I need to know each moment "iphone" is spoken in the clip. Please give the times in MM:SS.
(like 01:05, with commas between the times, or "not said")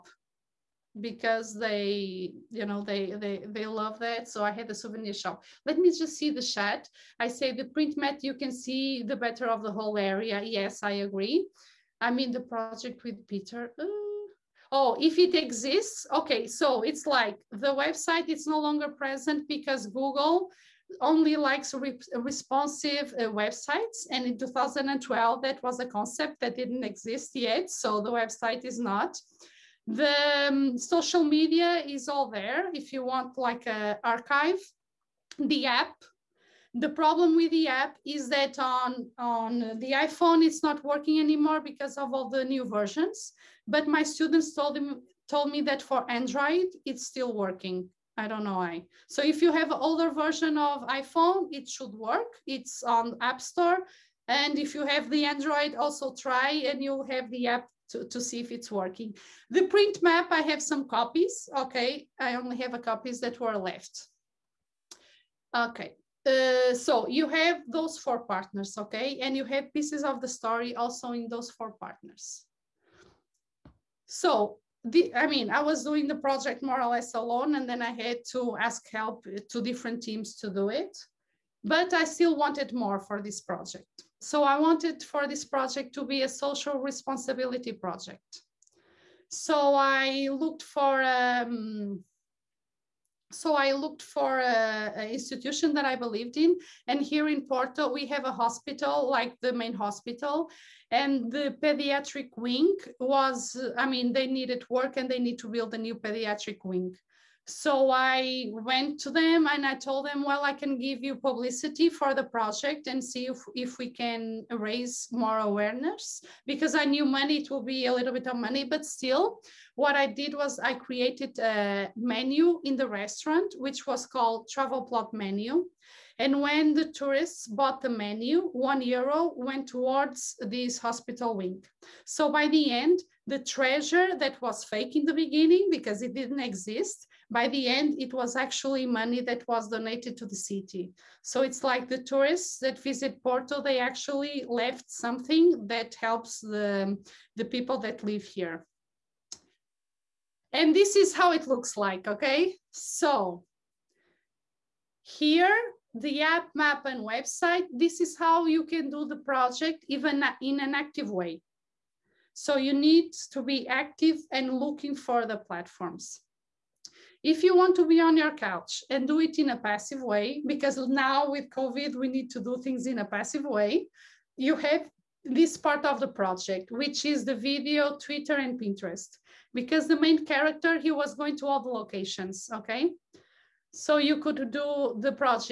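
00:39, 00:50.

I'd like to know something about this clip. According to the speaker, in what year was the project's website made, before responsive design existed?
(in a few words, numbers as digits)
2012.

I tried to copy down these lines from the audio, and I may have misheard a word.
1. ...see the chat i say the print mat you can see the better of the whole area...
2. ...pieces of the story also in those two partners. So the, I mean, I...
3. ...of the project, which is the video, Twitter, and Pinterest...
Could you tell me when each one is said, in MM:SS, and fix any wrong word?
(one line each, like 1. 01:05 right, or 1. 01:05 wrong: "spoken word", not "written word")
1. 00:06 right
2. 01:09 wrong: "four", not "two"
3. 02:55 right.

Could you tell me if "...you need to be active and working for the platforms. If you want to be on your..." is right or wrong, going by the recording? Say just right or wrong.
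wrong.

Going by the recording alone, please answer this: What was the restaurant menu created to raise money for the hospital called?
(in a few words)
Travel plot menu.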